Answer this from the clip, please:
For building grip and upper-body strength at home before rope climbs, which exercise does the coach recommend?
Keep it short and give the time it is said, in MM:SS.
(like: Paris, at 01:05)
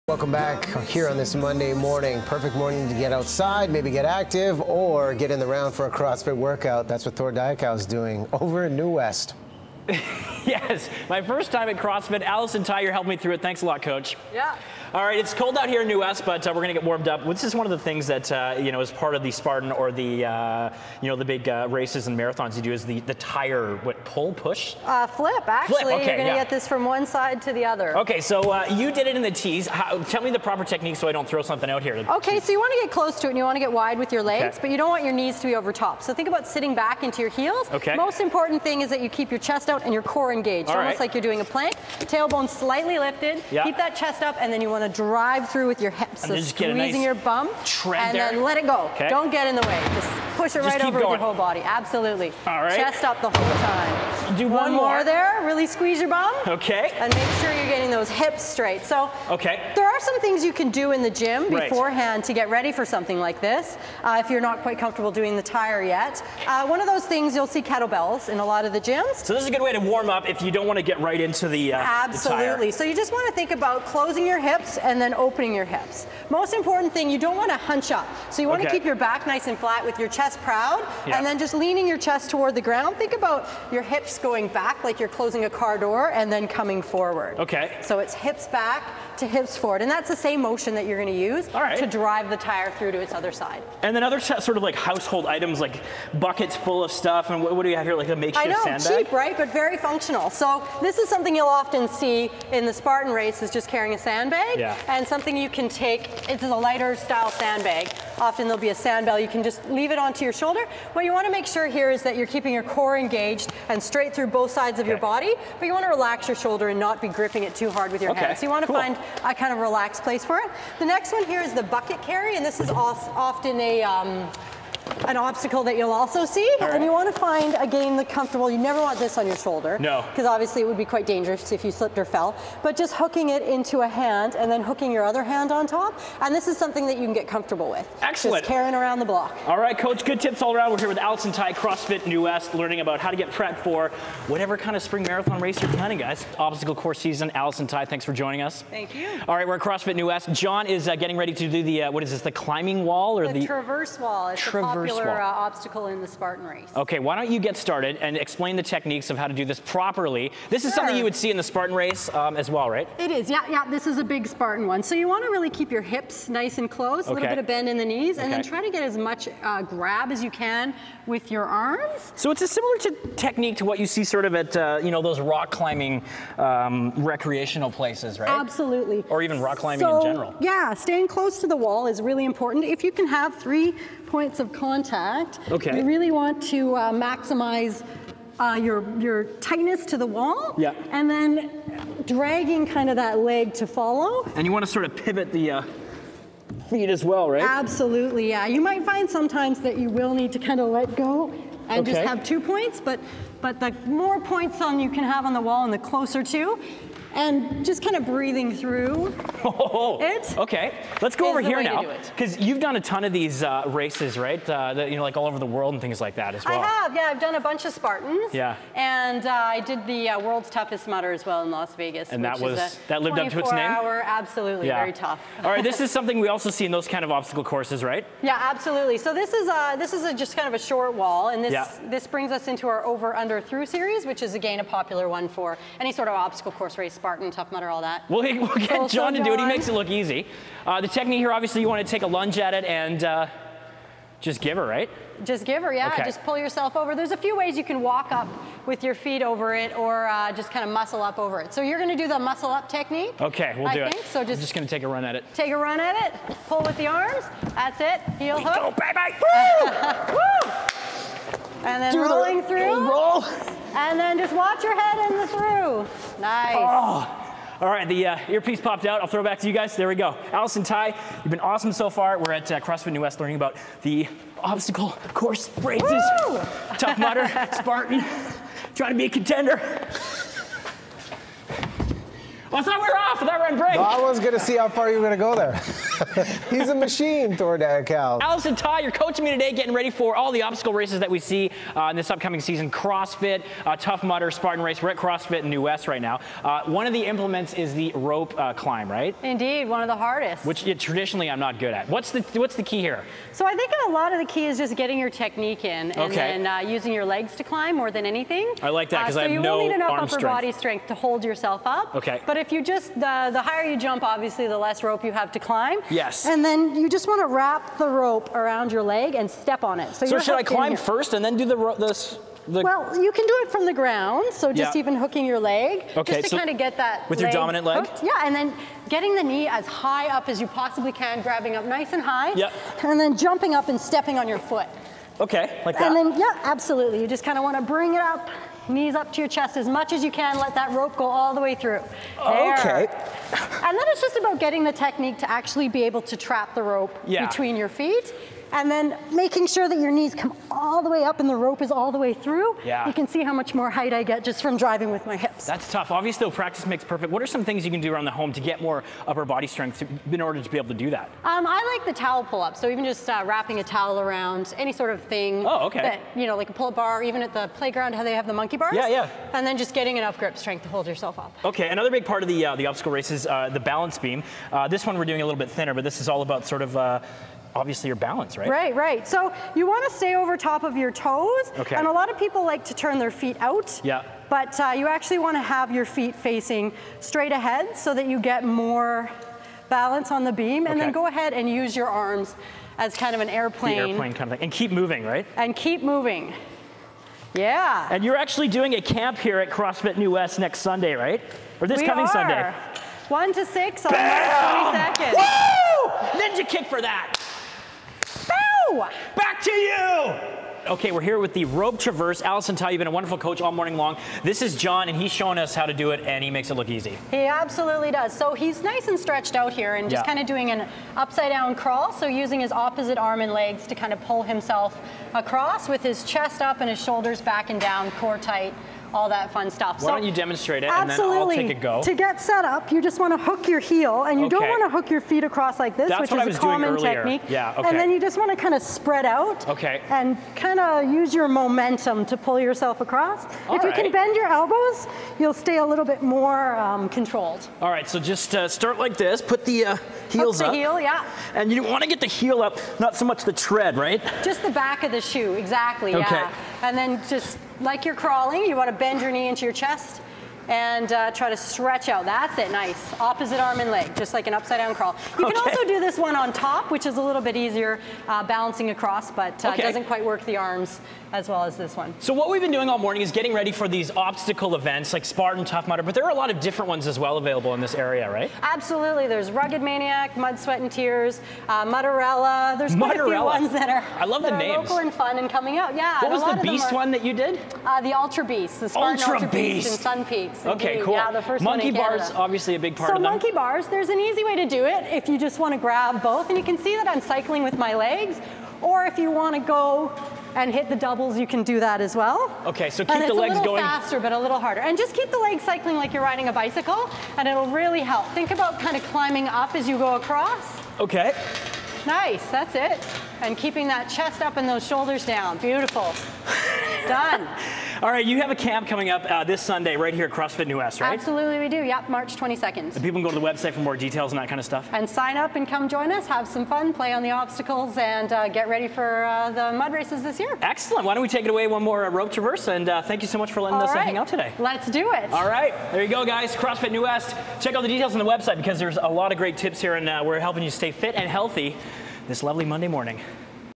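Towel pull-up, at 06:01.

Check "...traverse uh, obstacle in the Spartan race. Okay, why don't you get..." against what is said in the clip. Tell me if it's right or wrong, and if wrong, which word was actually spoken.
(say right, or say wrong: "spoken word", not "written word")
right.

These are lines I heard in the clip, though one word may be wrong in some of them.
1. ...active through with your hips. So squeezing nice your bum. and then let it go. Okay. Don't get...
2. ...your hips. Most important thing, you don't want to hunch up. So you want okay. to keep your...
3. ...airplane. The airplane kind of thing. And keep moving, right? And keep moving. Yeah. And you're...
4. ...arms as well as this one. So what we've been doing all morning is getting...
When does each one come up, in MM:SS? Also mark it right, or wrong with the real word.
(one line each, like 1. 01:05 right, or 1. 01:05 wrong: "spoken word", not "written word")
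1. 00:45 wrong: "drive", not "active"
2. 01:15 right
3. 06:33 right
4. 07:50 right.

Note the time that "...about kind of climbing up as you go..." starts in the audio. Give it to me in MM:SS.
08:28.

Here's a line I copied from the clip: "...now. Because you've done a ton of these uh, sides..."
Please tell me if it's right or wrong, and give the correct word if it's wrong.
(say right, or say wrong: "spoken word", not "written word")
wrong: "races", not "sides".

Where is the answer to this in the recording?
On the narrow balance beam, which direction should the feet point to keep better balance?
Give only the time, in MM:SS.
06:26.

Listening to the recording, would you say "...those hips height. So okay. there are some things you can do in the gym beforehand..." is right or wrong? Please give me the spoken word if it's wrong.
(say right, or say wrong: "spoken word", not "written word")
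wrong: "straight", not "height".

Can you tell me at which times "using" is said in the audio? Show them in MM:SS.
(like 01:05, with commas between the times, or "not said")
05:06, 07:02.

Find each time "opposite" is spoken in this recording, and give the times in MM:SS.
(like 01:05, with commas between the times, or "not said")
07:02, 07:42.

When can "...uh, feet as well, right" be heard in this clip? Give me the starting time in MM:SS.
03:15.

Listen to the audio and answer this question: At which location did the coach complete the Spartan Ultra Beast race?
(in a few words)
Sun Peaks.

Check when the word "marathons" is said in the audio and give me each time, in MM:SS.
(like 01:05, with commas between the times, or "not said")
00:22, 02:25.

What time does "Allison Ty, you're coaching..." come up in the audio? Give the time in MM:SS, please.
04:48.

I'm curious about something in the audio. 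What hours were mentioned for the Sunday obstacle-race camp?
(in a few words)
One to six.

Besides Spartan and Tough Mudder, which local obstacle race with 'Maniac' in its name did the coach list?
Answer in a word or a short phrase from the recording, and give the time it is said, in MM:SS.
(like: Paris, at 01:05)
Rugged Maniac, at 07:59.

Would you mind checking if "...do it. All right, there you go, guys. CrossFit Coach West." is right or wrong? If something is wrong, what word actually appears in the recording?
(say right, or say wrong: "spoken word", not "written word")
wrong: "New", not "Coach".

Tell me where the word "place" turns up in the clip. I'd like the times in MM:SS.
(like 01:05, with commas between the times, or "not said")
02:00, 02:57.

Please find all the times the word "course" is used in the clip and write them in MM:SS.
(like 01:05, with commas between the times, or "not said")
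02:26, 03:47, 03:56, 04:35.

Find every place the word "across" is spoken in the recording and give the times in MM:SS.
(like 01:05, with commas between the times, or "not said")
07:05, 07:15, 07:22, 07:48, 08:29.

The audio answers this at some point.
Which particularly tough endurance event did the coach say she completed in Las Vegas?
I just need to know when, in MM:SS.
03:40.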